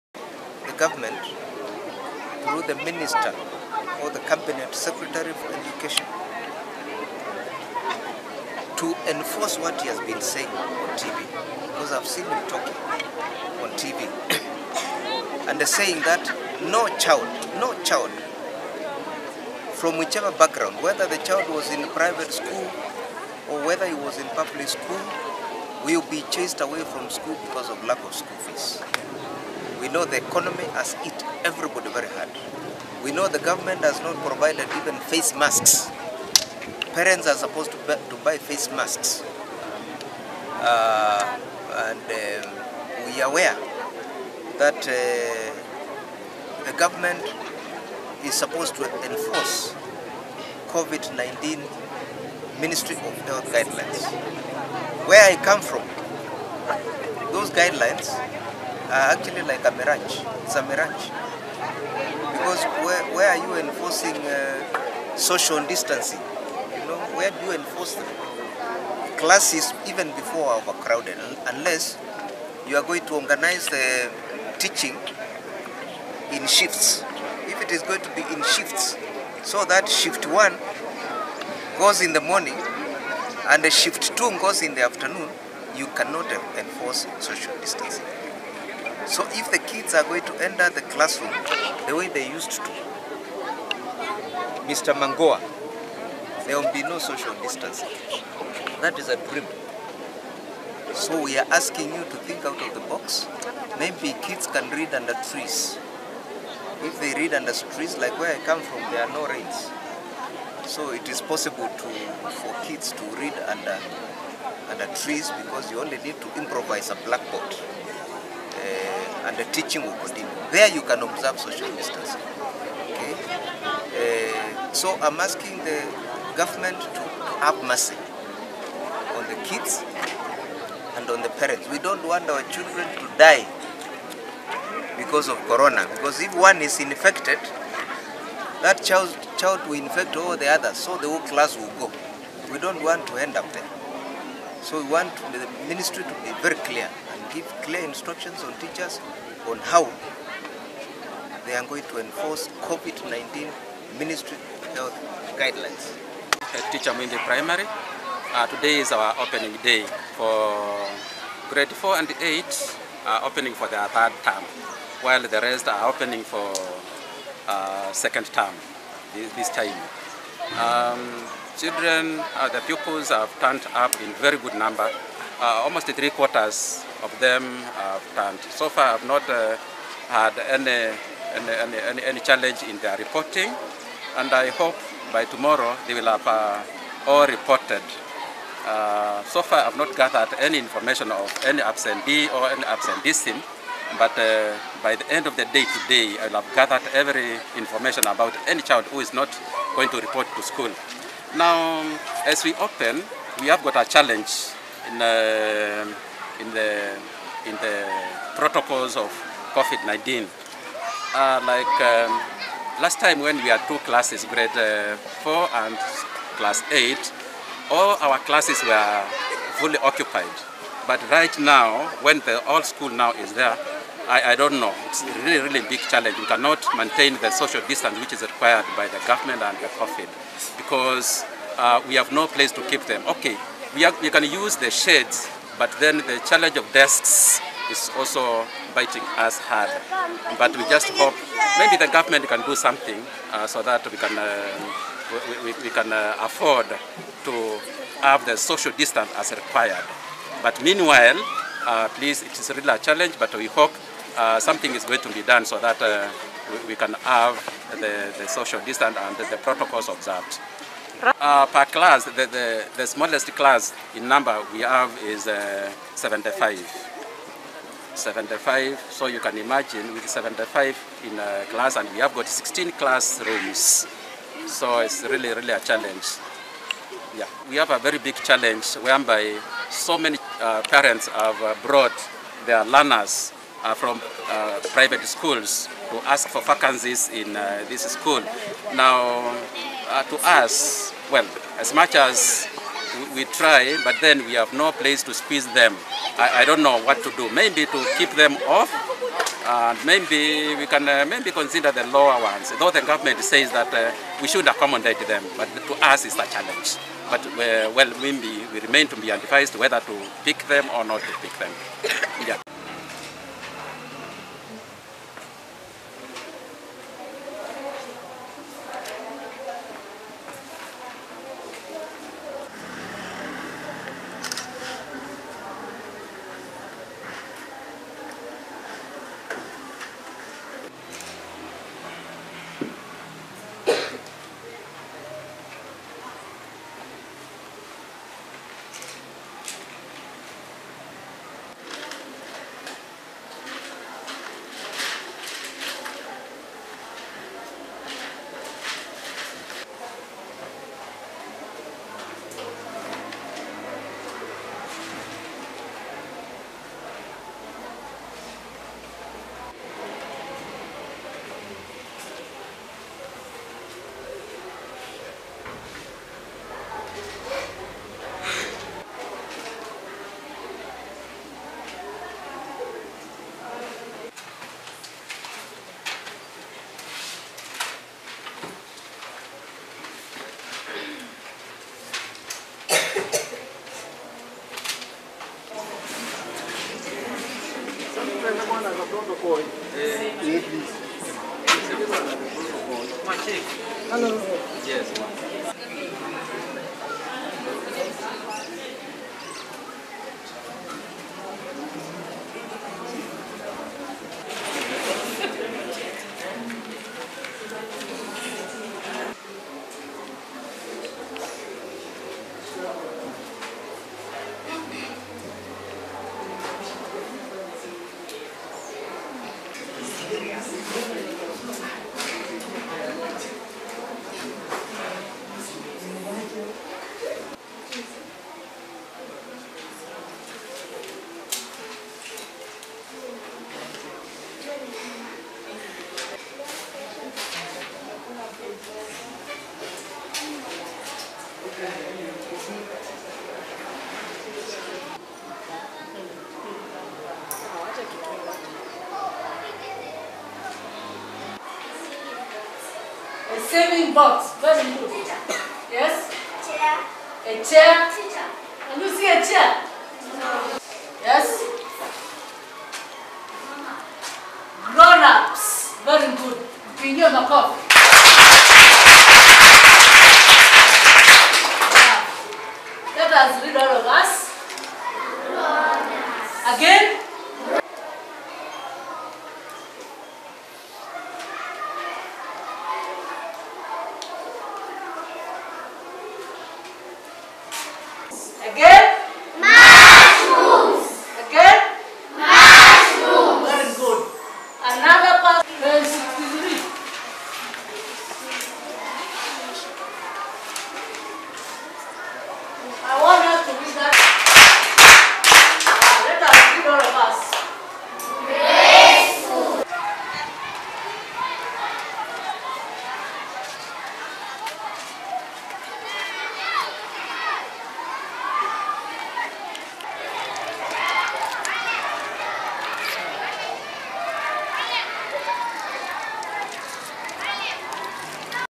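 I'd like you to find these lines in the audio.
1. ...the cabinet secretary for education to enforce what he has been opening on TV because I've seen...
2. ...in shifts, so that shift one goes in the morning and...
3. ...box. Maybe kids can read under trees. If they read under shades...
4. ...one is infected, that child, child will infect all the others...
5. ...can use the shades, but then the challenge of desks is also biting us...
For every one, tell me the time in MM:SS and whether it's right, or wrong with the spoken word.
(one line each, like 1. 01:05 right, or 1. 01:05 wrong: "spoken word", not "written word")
1. 00:04 wrong: "saying", not "opening"
2. 01:18 right
3. 01:42 wrong: "trees", not "shades"
4. 02:16 right
5. 03:54 right.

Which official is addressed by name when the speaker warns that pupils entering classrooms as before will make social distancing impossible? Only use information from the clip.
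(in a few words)
Mr. Magoha.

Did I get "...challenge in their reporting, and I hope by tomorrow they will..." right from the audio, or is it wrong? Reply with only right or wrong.
right.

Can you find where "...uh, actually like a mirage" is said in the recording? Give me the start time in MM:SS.
00:59.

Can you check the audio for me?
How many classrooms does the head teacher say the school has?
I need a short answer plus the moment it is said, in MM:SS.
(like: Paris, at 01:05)
16, at 04:32.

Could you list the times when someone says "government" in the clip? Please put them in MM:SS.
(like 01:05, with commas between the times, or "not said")
00:00, 00:33, 00:46, 02:06, 03:49, 04:01, 05:02.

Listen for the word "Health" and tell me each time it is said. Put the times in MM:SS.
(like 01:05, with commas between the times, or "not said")
00:53, 02:34.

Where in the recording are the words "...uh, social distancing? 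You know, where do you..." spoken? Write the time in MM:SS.
01:04.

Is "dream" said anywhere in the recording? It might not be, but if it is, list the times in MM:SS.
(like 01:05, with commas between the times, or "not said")
01:39.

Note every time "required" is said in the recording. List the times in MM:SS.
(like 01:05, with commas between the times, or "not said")
03:48, 04:09.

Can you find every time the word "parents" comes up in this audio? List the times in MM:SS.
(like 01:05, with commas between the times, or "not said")
00:36, 02:11, 04:40.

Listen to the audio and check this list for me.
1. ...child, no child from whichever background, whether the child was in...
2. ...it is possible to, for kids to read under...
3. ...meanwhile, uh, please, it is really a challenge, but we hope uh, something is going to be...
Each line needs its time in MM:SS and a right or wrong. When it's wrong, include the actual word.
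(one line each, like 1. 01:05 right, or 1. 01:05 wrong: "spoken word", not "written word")
1. 00:16 right
2. 01:50 right
3. 04:10 right.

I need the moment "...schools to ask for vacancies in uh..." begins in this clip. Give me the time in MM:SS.
04:45.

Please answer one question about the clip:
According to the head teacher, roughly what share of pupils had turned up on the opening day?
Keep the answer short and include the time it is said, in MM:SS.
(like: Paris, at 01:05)
Three quarters, at 02:55.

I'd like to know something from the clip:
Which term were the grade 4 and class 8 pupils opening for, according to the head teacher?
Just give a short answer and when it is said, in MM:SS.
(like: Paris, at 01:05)
Third term, at 02:43.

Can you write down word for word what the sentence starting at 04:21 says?
Uh, per class, the, the, the, smallest class in number we have is uh, 75.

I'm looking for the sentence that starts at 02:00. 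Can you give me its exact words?
There you can observe social distancing.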